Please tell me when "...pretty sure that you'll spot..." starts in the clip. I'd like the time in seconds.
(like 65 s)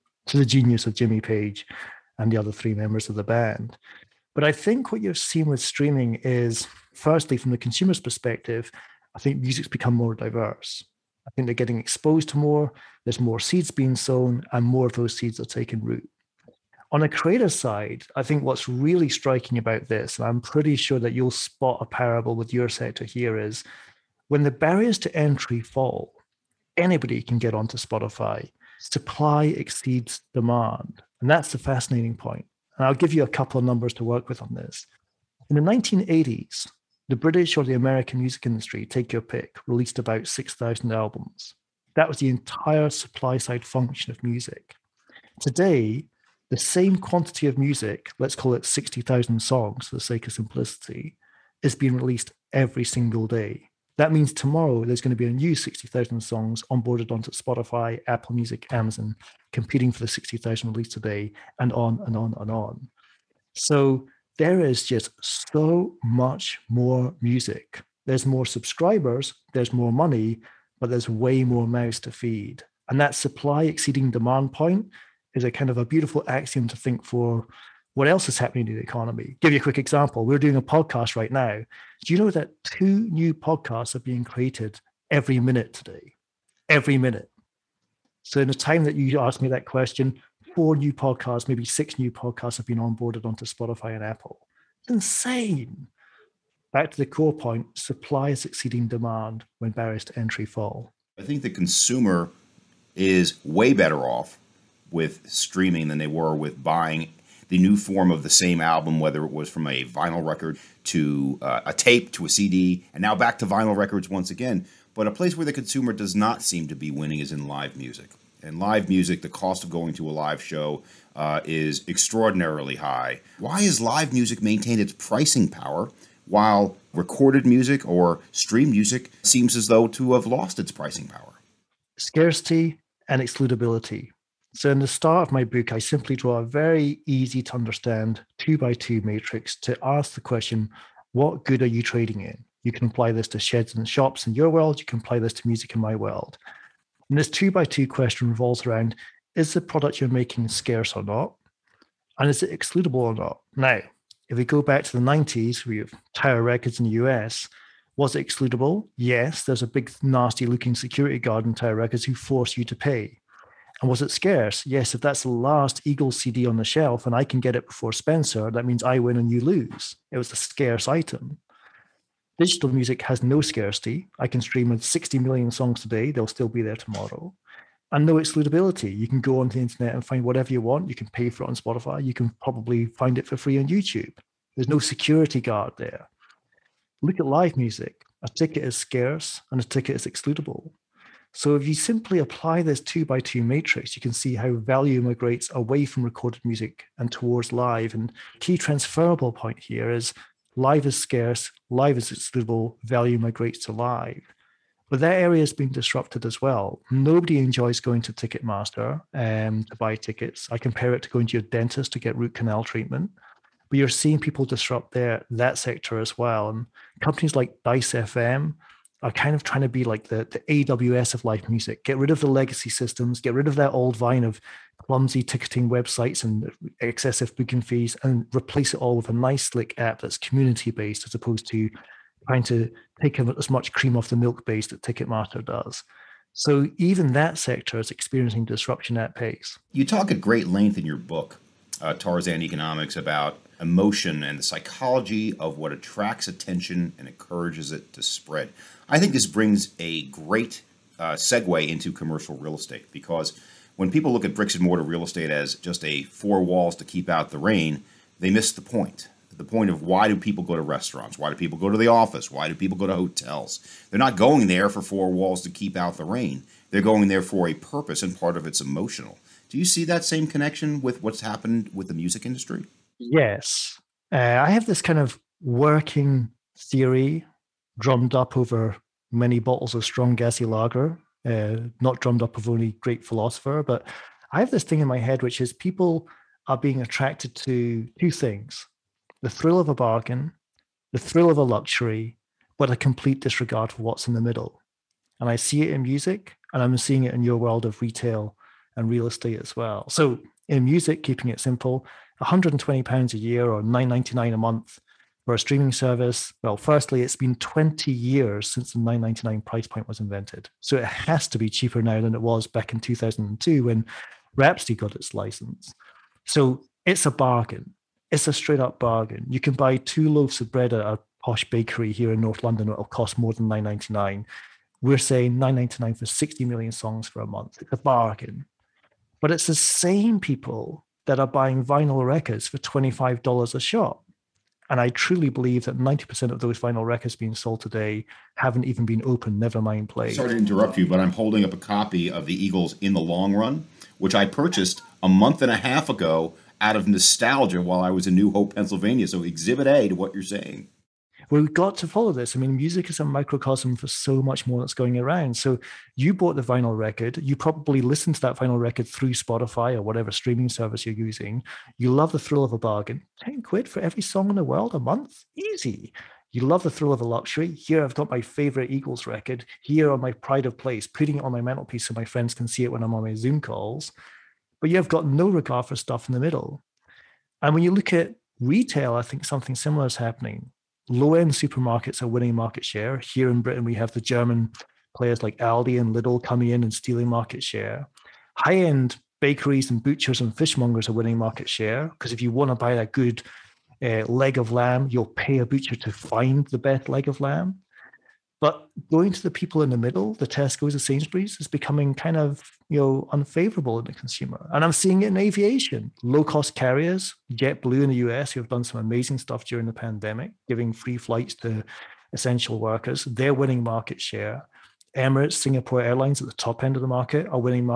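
20 s.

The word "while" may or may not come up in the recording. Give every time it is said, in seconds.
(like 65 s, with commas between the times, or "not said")
126 s, 347 s.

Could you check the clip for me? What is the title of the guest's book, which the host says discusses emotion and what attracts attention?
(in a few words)
Tarzan Economics.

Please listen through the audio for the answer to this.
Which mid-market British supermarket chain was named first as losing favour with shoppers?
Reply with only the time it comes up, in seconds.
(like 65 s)
400 s.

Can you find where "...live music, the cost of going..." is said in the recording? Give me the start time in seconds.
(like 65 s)
118 s.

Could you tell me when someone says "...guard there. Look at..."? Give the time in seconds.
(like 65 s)
185 s.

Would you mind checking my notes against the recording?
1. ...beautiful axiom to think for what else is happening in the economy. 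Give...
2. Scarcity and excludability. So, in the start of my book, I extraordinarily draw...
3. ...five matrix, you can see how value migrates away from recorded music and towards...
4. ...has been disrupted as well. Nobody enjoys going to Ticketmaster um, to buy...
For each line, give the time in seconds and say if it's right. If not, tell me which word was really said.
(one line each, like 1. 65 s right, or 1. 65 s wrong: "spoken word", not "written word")
1. 75 s right
2. 131 s wrong: "simply", not "extraordinarily"
3. 193 s wrong: "two", not "five"
4. 205 s right.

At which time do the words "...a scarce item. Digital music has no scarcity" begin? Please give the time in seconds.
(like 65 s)
170 s.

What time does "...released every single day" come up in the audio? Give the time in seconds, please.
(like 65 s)
51 s.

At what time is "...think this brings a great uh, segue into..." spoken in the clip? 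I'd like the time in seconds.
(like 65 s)
248 s.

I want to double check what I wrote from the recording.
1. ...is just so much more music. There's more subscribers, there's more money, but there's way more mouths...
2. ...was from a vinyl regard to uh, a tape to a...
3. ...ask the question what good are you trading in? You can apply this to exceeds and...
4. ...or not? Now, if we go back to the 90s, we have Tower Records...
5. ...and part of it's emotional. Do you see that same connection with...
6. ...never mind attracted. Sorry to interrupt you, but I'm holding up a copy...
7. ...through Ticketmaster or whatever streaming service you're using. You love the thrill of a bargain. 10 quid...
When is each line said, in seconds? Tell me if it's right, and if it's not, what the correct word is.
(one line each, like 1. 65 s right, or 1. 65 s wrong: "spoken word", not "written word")
1. 64 s right
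2. 109 s wrong: "record", not "regard"
3. 139 s wrong: "sheds", not "exceeds"
4. 153 s right
5. 268 s right
6. 339 s wrong: "played", not "attracted"
7. 358 s wrong: "Spotify", not "Ticketmaster".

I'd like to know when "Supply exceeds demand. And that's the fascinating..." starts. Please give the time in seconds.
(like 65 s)
28 s.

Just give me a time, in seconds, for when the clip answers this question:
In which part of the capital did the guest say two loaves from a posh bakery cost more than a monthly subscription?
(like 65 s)
322 s.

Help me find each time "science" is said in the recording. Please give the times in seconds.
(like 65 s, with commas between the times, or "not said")
not said.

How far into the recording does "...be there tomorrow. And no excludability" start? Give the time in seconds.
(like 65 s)
176 s.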